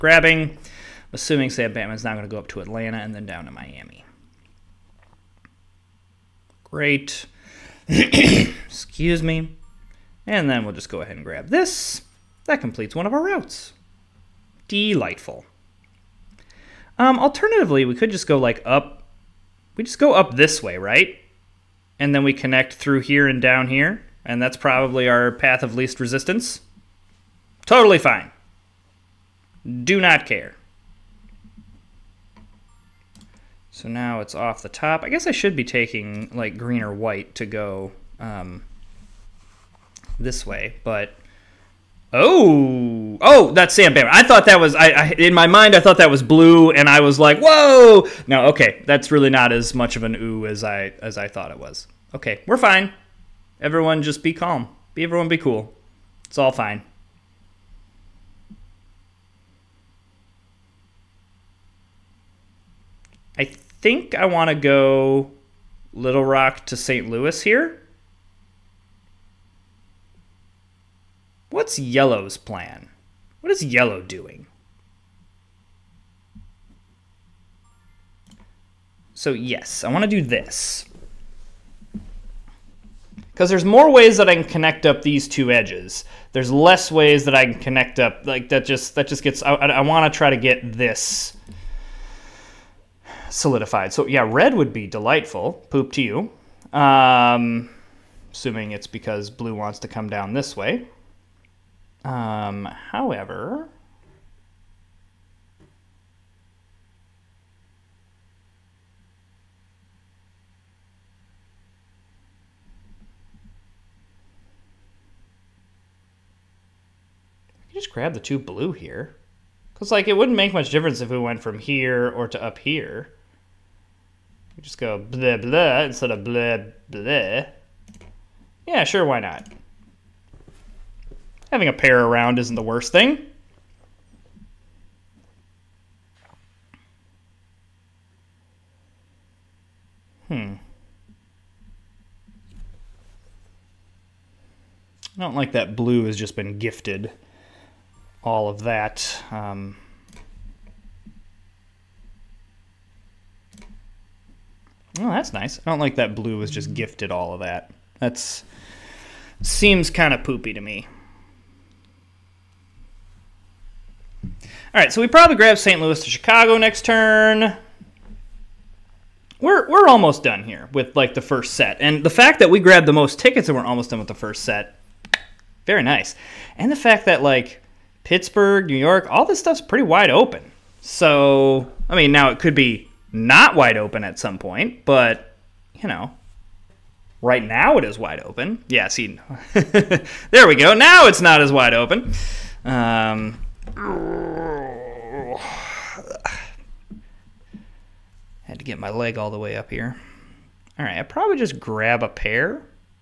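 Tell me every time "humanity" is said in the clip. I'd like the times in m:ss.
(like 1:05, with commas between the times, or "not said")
not said.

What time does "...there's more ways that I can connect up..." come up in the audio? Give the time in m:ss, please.
1:23.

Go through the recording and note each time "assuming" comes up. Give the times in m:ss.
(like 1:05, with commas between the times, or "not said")
0:01, 1:38.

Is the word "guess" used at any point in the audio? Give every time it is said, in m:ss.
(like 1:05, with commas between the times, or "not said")
0:35.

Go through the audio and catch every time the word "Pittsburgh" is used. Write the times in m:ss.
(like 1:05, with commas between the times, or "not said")
2:58.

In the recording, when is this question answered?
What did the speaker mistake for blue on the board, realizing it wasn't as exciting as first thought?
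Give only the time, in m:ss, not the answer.
0:43.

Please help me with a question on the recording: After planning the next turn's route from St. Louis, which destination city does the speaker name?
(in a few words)
Chicago.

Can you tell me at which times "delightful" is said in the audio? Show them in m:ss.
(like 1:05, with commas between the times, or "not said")
0:14, 1:34.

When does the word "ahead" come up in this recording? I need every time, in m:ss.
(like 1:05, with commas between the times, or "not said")
0:11.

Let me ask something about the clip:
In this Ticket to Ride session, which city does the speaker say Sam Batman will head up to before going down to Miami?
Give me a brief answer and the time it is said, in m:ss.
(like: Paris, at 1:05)
Atlanta, at 0:02.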